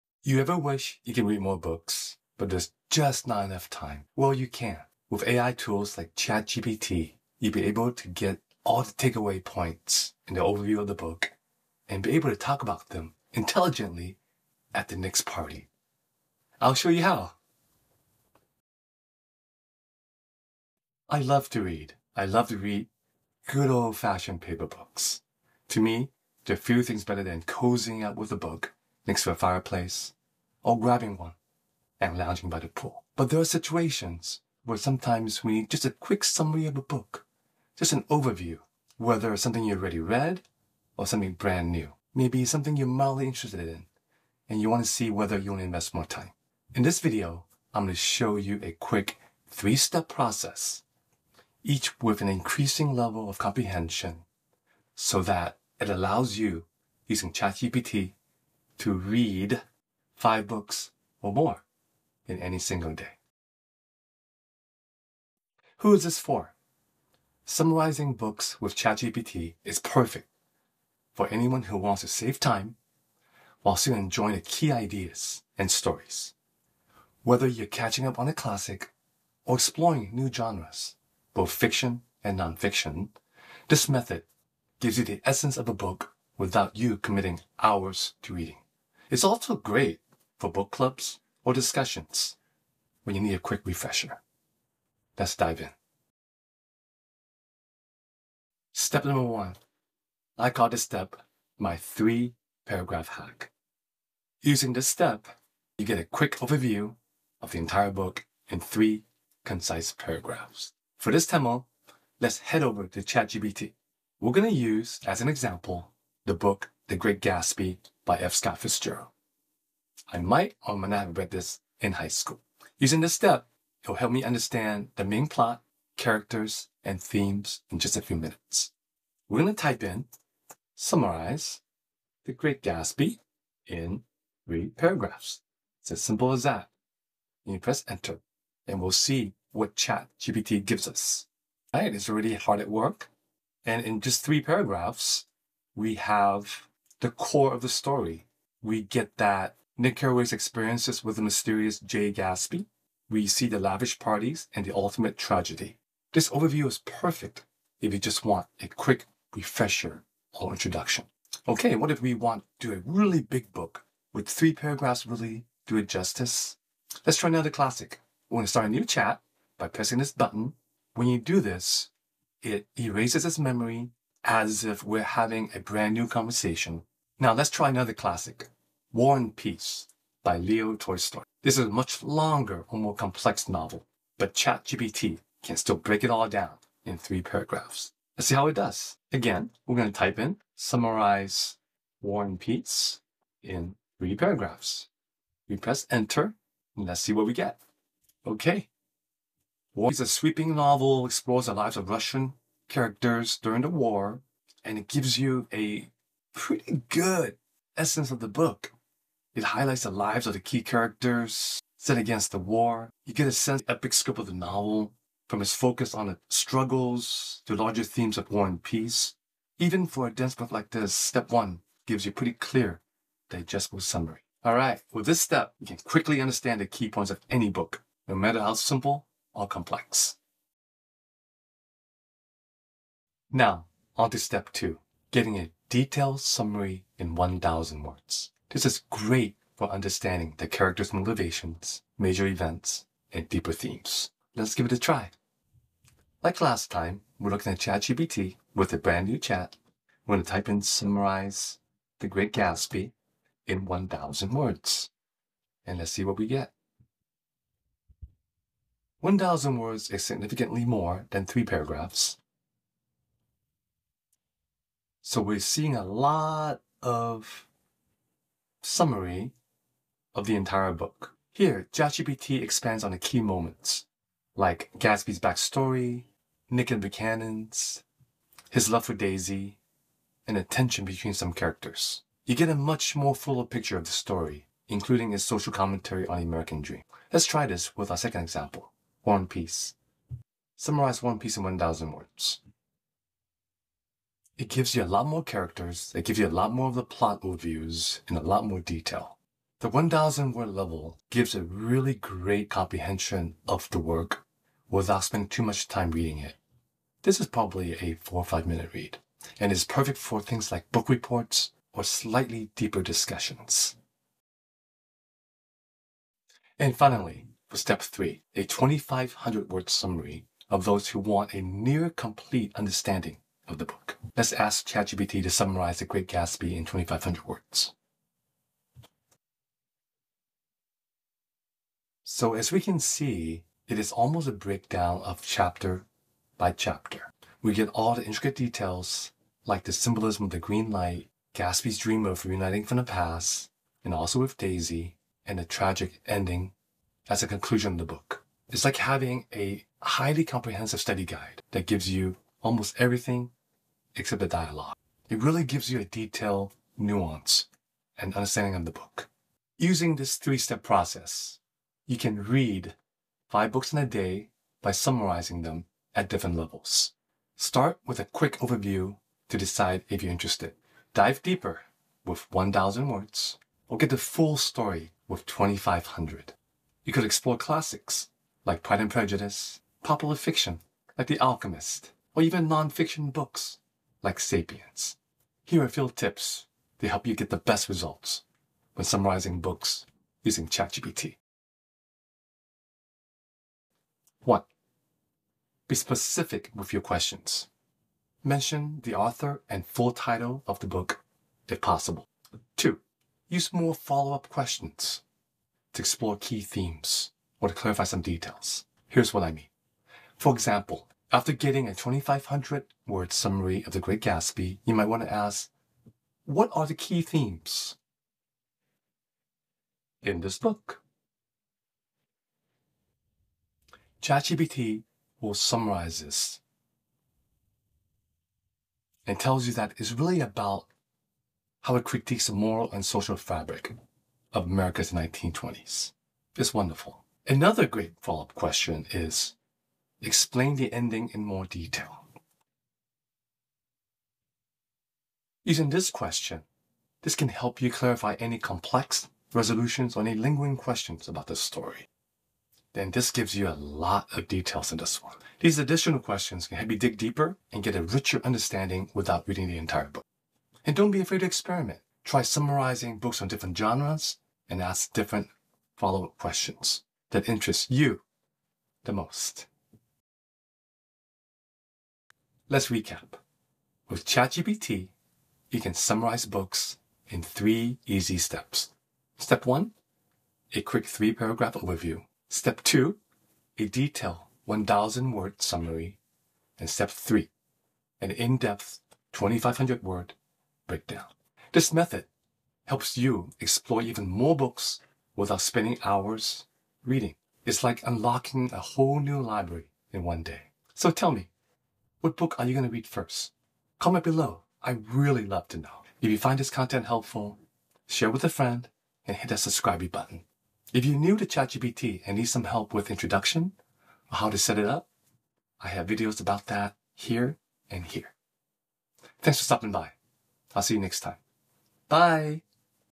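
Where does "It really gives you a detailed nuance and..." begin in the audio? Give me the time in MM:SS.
05:55.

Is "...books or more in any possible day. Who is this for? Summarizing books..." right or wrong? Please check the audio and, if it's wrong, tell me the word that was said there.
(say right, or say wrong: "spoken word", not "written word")
wrong: "single", not "possible".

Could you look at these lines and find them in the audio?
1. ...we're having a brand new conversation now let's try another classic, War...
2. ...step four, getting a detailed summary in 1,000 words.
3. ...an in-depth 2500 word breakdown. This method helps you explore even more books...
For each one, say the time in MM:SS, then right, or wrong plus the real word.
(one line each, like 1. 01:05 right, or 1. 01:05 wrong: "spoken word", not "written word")
1. 02:54 right
2. 03:54 wrong: "two", not "four"
3. 08:08 right.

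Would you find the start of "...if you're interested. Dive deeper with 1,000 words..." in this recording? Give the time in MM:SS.
06:09.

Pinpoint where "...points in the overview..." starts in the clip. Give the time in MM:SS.
00:09.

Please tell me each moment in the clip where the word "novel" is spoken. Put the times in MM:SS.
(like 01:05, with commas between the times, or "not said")
03:03, 03:20, 03:34.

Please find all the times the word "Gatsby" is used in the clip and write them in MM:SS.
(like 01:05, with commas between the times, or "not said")
01:57, 02:12, 02:32, 04:12, 04:34, 05:26, 05:41, 06:54.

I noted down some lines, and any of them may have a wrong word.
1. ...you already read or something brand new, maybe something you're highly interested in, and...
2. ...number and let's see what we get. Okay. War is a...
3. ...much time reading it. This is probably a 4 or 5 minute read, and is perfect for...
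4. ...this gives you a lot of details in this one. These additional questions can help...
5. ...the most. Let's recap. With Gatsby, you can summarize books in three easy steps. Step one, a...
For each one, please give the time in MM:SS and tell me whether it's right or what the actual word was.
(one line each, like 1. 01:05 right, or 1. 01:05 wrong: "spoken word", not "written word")
1. 00:39 wrong: "mildly", not "highly"
2. 03:15 wrong: "enter", not "number"
3. 05:05 right
4. 07:32 right
5. 07:48 wrong: "ChatGPT", not "Gatsby".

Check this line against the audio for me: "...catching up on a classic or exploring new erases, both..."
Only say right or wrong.
wrong.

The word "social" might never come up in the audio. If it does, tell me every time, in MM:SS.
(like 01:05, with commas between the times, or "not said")
04:45, 07:12.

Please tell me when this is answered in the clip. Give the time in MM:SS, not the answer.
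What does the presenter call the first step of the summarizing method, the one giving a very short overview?
01:41.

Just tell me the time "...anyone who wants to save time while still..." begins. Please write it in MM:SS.
01:11.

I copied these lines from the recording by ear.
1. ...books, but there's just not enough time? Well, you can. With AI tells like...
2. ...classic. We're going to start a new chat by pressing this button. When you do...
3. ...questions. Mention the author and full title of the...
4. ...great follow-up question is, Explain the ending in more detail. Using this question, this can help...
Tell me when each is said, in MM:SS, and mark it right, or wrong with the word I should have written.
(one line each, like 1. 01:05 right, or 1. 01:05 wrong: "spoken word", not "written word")
1. 00:01 wrong: "tools", not "tells"
2. 02:47 right
3. 06:36 right
4. 07:17 right.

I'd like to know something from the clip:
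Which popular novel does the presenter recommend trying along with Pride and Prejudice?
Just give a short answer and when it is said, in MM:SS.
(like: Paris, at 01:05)
The Alchemist, at 06:21.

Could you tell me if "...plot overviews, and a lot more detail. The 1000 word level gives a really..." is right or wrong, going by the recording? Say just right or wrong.
right.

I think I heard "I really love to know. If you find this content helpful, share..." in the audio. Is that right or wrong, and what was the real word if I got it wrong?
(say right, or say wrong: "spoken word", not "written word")
right.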